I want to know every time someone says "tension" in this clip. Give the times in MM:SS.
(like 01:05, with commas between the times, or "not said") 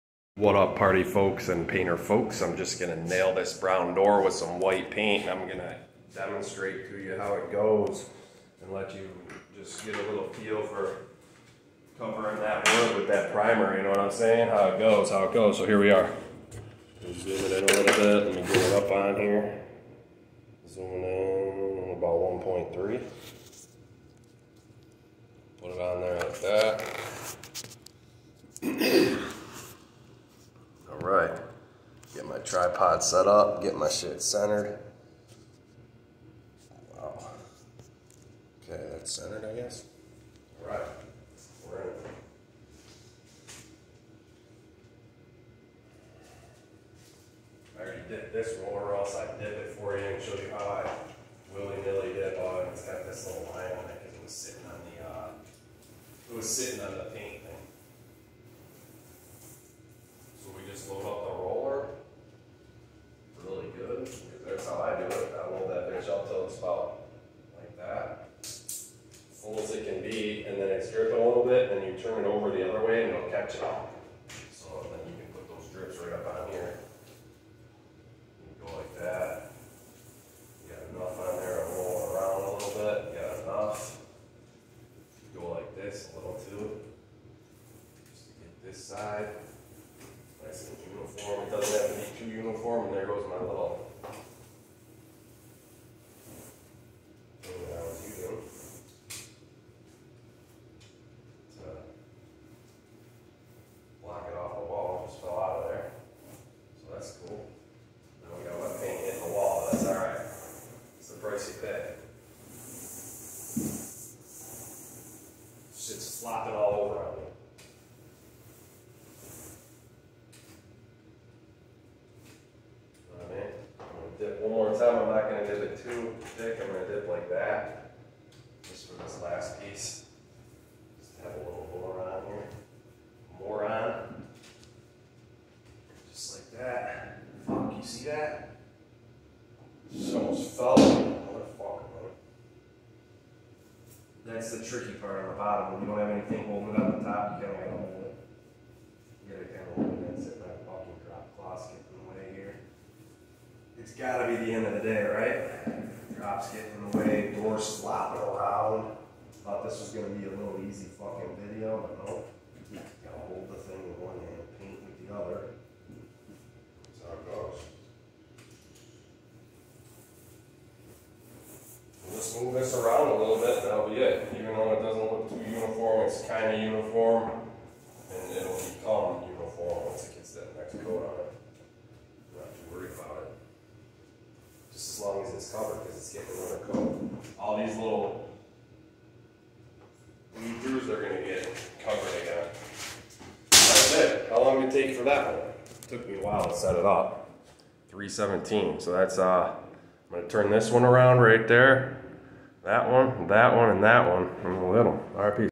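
not said.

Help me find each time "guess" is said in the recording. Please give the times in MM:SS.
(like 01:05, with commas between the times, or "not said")
00:39.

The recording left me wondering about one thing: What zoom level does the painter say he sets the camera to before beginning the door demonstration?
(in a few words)
1.3.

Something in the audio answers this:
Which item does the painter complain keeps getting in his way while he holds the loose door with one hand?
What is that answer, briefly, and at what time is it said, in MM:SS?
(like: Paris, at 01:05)
Drop cloth, at 02:31.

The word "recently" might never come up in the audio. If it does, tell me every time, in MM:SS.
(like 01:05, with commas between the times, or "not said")
not said.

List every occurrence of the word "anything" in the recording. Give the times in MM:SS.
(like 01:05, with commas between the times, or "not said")
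02:26.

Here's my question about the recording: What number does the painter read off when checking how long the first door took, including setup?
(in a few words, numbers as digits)
317.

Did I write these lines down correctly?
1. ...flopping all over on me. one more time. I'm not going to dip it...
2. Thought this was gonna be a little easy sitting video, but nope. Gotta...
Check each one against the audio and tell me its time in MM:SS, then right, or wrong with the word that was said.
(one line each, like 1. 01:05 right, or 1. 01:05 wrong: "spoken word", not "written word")
1. 01:56 right
2. 02:39 wrong: "fucking", not "sitting".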